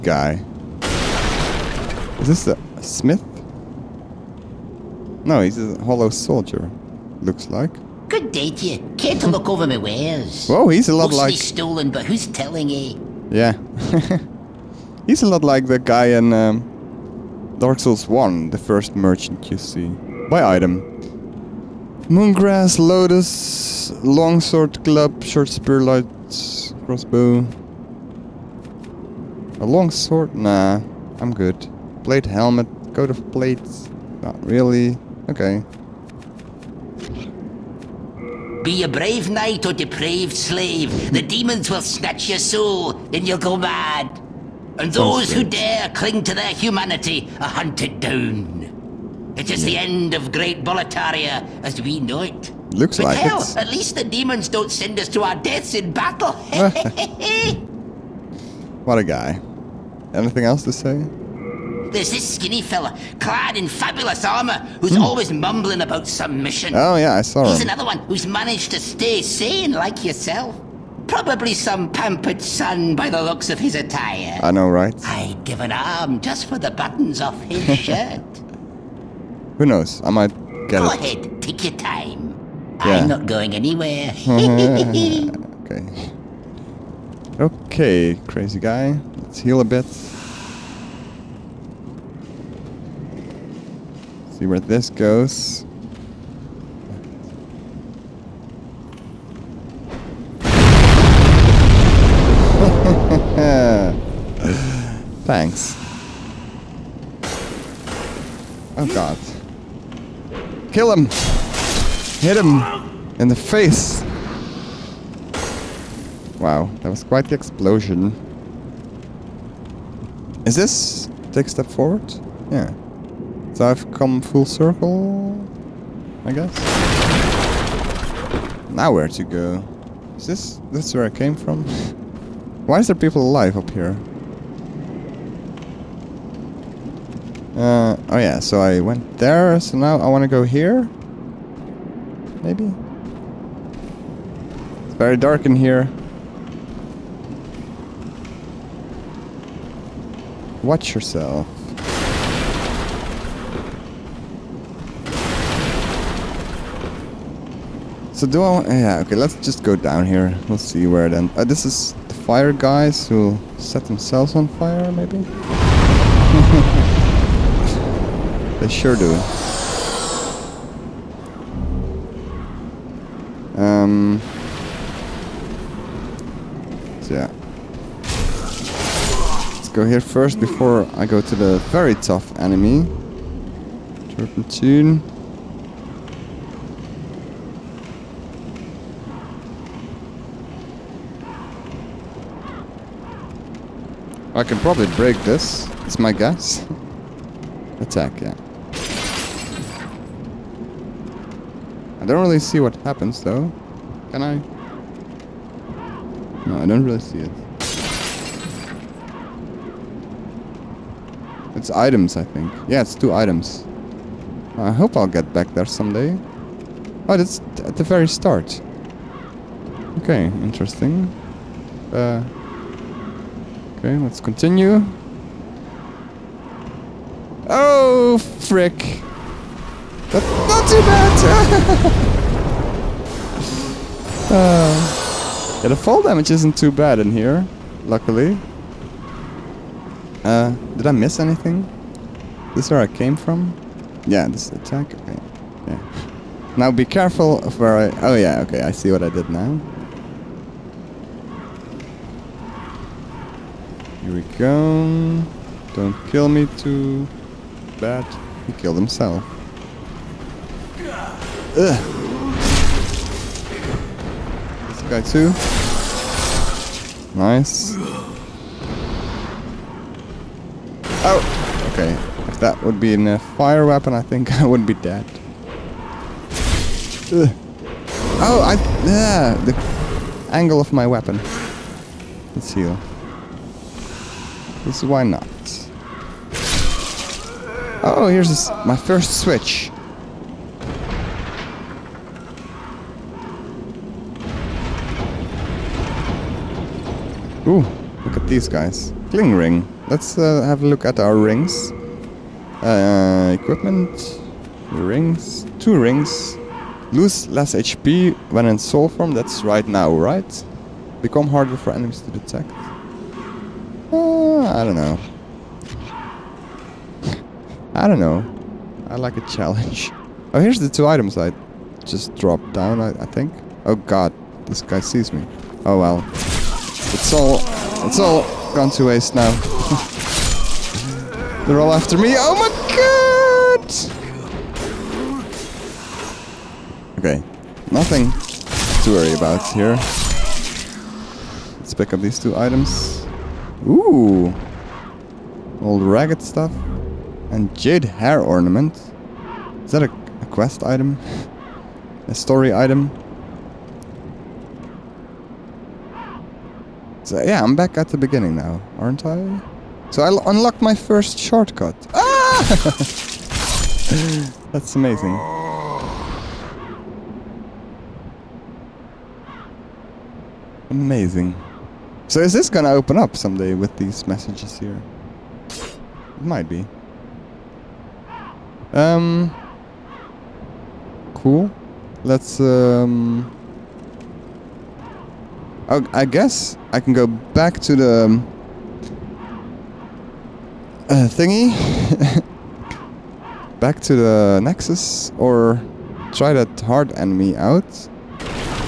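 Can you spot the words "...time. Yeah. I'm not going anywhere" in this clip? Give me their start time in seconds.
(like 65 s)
81 s.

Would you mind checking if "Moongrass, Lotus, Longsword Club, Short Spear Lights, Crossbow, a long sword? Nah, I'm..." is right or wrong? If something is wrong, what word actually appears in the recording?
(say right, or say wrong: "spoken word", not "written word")
right.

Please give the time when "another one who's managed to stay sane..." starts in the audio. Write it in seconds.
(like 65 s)
67 s.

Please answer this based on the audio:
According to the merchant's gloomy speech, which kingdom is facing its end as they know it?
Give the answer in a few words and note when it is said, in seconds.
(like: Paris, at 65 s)
Boletaria, at 50 s.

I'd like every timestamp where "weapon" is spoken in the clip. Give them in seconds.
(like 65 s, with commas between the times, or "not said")
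273 s, 280 s.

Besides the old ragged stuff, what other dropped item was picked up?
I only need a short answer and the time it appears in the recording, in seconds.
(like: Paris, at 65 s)
Jade hair ornament, at 347 s.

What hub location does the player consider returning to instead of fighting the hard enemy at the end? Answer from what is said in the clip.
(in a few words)
The Nexus.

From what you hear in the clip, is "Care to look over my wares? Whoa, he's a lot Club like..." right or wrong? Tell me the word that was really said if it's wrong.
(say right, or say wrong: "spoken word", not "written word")
wrong: "Mostly", not "Club".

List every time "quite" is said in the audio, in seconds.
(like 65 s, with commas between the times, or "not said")
117 s.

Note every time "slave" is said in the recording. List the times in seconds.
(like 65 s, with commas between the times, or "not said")
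40 s.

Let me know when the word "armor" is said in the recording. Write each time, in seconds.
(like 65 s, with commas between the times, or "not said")
64 s.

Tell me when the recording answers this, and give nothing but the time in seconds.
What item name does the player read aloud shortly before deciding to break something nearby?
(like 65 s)
184 s.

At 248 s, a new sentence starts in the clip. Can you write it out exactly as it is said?
Oh yeah, okay, I see what I did now.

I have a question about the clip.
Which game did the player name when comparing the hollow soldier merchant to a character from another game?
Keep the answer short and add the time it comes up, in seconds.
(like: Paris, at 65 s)
Dark Souls 1, at 17 s.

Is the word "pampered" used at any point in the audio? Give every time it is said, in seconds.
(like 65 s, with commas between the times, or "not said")
71 s.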